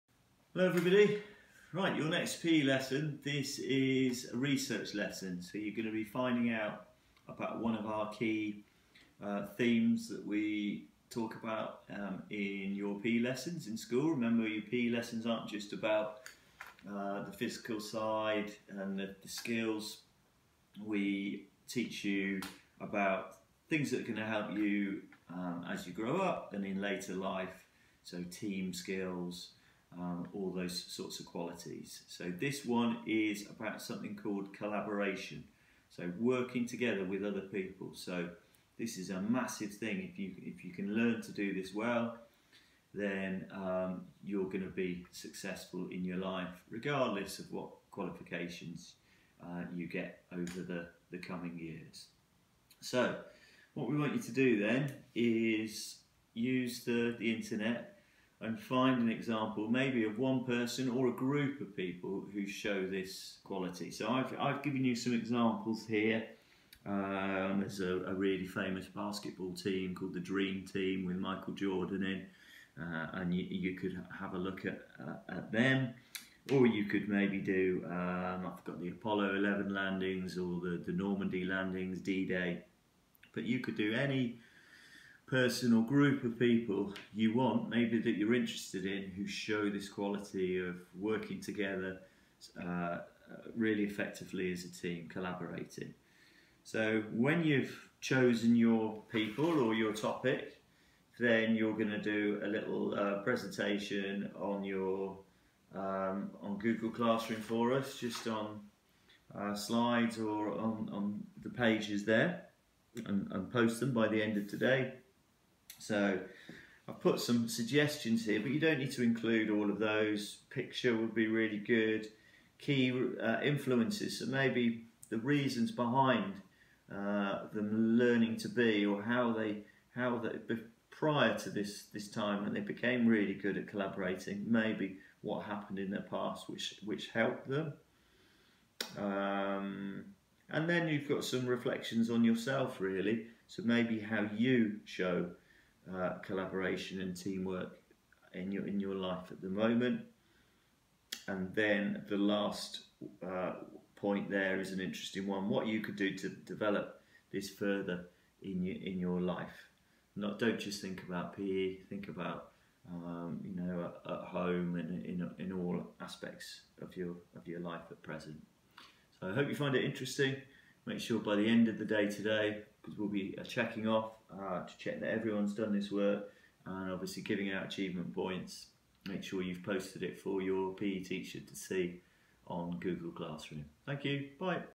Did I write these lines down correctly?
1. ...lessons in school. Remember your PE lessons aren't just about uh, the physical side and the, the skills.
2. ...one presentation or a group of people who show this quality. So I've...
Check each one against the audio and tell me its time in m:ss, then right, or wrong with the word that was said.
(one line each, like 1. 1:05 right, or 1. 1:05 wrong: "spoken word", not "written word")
1. 0:13 right
2. 1:00 wrong: "person", not "presentation".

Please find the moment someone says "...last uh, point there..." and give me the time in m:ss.
2:32.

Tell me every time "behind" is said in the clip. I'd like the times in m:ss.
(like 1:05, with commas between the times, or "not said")
2:05.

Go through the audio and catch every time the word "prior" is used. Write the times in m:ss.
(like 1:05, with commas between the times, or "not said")
2:10.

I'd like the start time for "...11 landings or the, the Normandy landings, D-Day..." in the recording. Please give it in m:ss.
1:19.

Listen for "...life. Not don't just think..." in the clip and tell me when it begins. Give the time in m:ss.
2:39.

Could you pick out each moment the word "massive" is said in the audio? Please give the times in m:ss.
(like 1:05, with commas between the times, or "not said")
0:39.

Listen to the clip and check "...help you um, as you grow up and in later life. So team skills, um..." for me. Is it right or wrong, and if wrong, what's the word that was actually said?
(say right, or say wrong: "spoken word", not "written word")
right.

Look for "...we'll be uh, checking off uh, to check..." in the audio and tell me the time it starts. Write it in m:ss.
2:52.